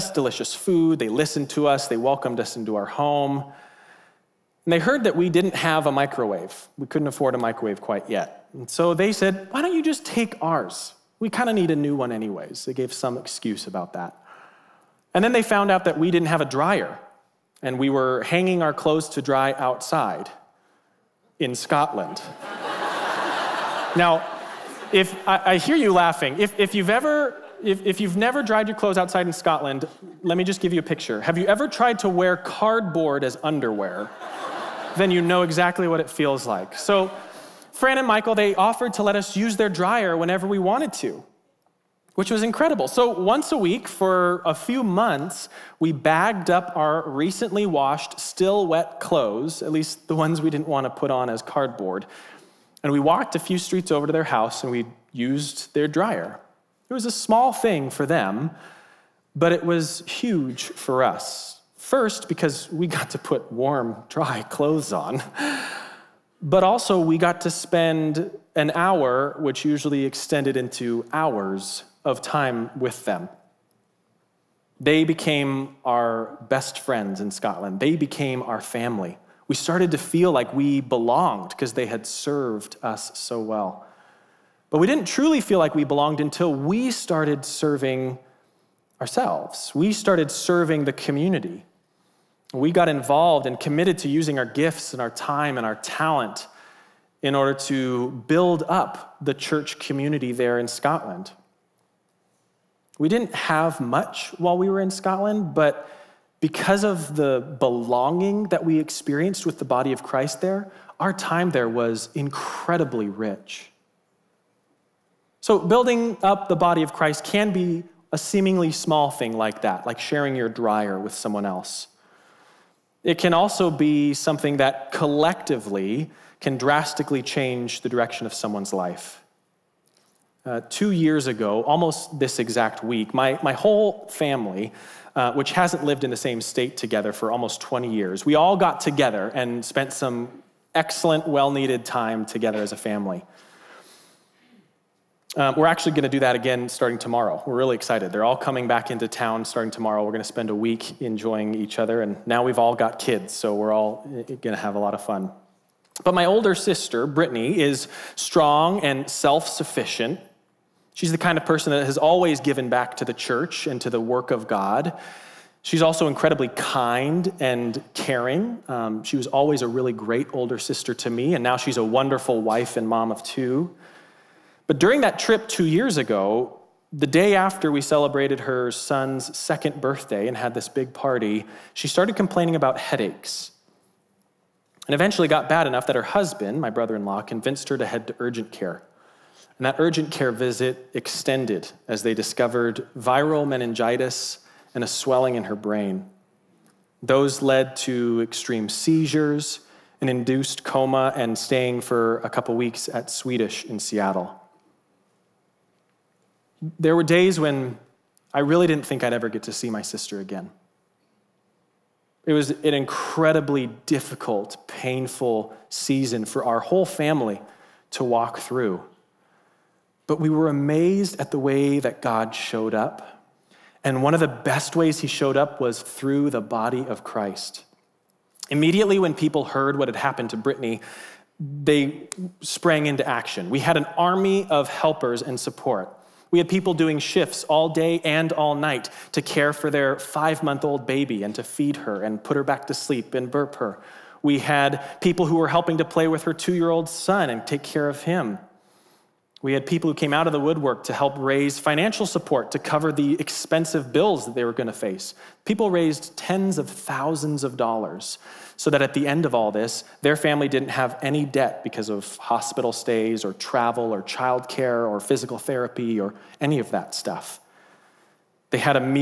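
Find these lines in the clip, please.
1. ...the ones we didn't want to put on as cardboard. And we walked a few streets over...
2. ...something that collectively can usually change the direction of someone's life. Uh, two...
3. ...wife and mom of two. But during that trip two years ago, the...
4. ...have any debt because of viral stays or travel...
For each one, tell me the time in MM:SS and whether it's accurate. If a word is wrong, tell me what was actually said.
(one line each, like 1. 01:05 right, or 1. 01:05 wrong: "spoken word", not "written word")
1. 00:50 right
2. 02:04 wrong: "drastically", not "usually"
3. 02:52 right
4. 04:20 wrong: "hospital", not "viral".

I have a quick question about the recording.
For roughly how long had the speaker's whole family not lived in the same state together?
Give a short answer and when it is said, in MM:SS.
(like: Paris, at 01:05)
20 years, at 02:17.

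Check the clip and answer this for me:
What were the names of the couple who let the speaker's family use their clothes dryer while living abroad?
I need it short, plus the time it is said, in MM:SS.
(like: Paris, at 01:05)
Fran and Michael, at 00:37.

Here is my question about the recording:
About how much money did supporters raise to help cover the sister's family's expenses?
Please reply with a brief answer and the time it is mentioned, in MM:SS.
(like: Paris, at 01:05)
Tens of thousands of dollars, at 04:16.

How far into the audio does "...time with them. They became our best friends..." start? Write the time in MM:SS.
01:12.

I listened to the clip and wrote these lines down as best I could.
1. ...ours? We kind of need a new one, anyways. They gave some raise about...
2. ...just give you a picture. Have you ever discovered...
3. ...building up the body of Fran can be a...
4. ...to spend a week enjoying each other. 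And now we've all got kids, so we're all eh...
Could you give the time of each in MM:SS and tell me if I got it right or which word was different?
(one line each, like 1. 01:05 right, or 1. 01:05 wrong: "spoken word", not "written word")
1. 00:10 wrong: "excuse", not "raise"
2. 00:30 wrong: "tried", not "discovered"
3. 01:55 wrong: "Christ", not "Fran"
4. 02:30 right.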